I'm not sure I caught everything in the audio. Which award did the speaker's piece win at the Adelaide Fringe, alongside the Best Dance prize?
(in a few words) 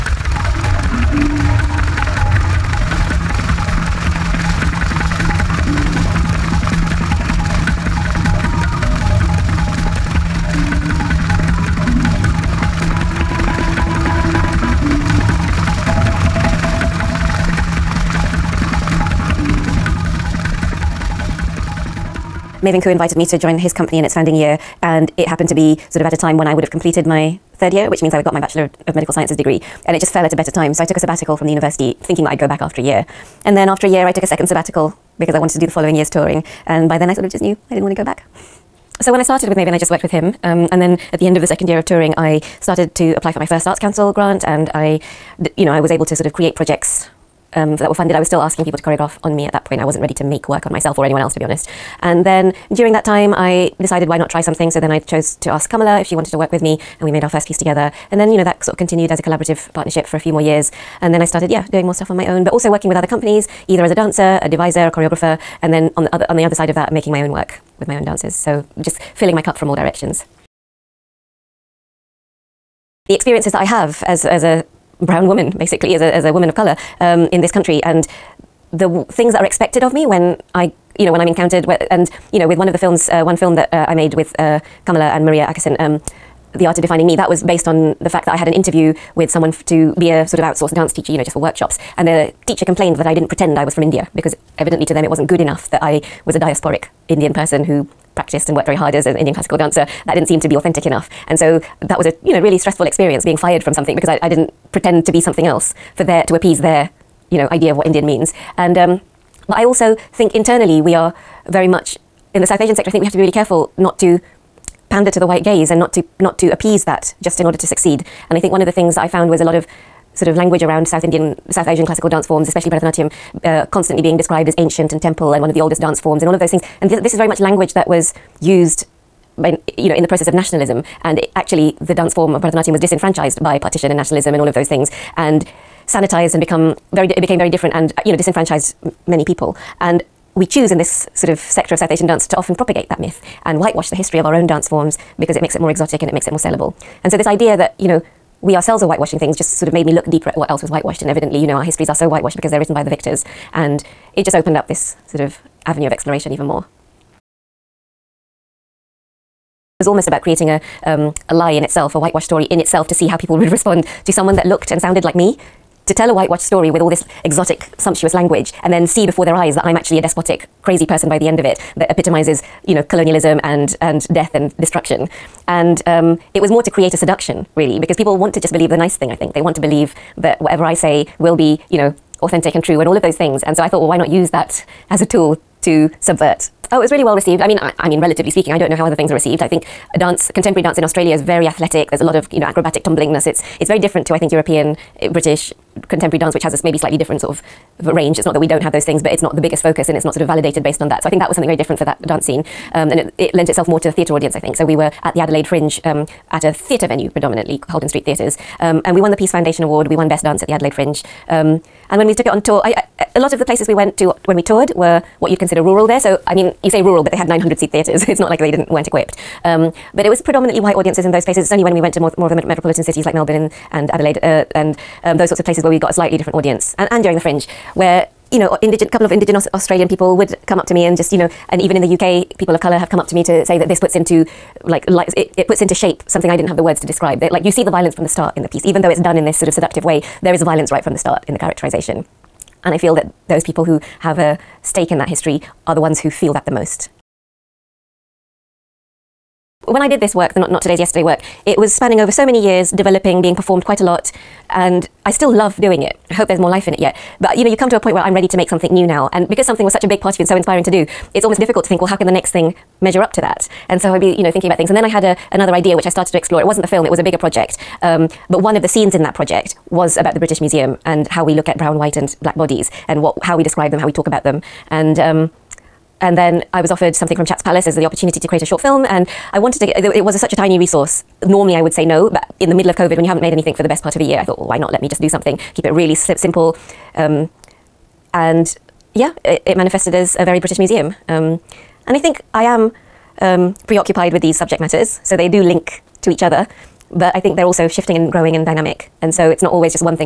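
Peace Foundation Award.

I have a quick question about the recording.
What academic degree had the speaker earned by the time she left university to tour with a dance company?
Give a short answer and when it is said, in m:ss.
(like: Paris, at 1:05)
Bachelor of Medical Sciences, at 0:28.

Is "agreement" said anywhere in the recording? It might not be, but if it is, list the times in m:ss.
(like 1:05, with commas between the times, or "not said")
not said.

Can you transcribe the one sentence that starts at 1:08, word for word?
So just filling my cup from all directions.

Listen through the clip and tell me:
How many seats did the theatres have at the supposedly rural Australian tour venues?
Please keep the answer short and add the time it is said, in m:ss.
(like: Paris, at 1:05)
900, at 3:37.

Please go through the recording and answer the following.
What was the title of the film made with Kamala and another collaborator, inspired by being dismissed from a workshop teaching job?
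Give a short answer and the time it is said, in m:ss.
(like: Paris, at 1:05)
The Art of Defining Me, at 1:26.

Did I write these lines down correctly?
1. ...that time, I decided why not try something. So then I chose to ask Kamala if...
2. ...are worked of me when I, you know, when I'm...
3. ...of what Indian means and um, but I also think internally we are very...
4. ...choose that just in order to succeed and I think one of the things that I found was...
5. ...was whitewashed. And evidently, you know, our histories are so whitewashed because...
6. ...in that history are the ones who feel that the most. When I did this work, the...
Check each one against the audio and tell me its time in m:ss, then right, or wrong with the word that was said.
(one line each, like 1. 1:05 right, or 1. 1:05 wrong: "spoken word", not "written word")
1. 0:52 right
2. 1:19 wrong: "expected", not "worked"
3. 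1:47 right
4. 1:56 wrong: "appease", not "choose"
5. 2:30 right
6. 4:04 right.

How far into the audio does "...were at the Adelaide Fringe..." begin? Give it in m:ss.
3:24.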